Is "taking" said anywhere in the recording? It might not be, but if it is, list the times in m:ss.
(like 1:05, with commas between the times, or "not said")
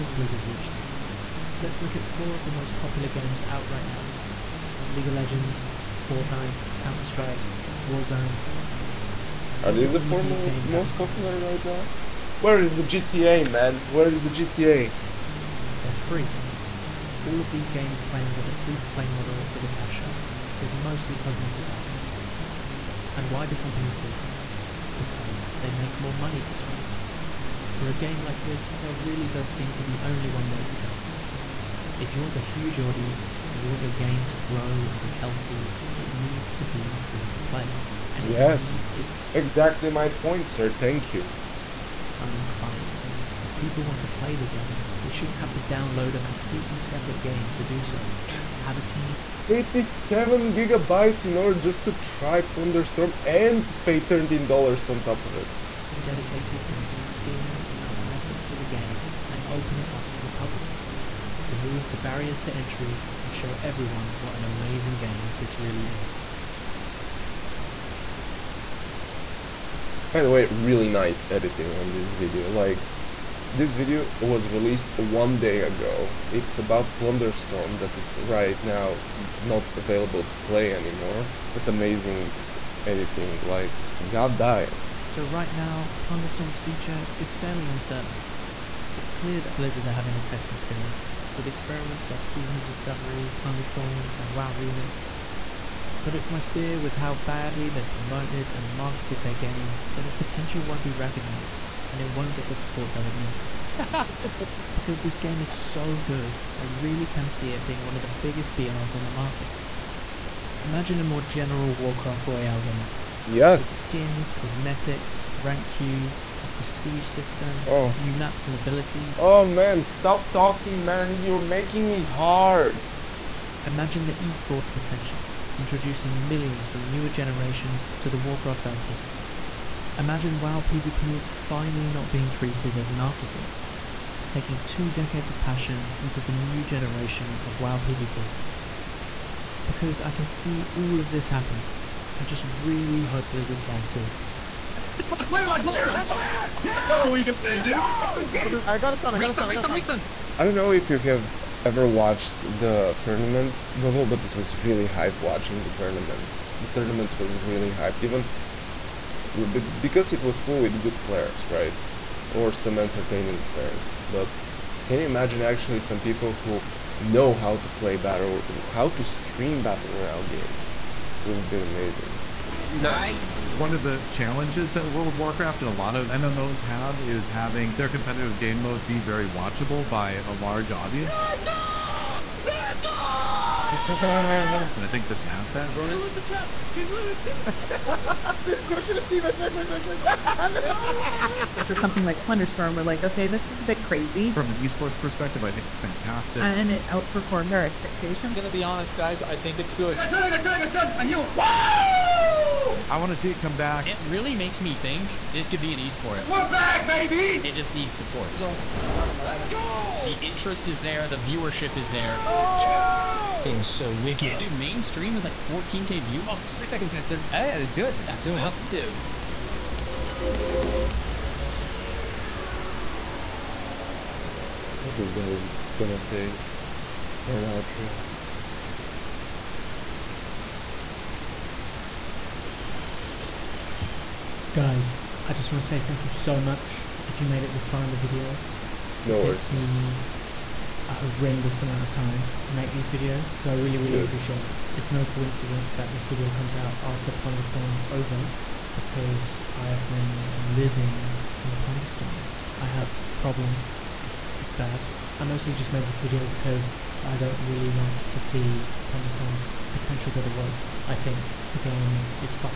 2:14.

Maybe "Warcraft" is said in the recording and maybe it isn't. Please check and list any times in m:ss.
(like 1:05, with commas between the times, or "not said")
1:51, 2:08, 2:55.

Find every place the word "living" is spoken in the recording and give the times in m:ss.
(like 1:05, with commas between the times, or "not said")
4:10.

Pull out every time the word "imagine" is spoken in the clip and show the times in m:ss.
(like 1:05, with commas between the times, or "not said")
1:50, 2:03, 2:09, 2:45.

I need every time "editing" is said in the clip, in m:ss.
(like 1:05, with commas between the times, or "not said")
1:11, 1:22.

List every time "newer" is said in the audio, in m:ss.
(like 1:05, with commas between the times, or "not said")
2:06.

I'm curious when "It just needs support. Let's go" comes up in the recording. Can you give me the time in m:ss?
3:27.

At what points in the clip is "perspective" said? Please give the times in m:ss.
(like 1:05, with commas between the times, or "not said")
3:14.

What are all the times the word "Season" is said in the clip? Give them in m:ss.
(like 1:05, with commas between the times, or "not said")
1:32.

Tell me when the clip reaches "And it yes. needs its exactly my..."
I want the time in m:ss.
0:38.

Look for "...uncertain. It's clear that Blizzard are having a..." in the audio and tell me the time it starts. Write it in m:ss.
1:27.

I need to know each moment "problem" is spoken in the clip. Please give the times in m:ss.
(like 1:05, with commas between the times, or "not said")
4:13.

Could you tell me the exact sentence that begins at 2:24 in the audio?
I don't know if you have ever watched the tournaments, Bubble, but it was really hype watching the tournaments.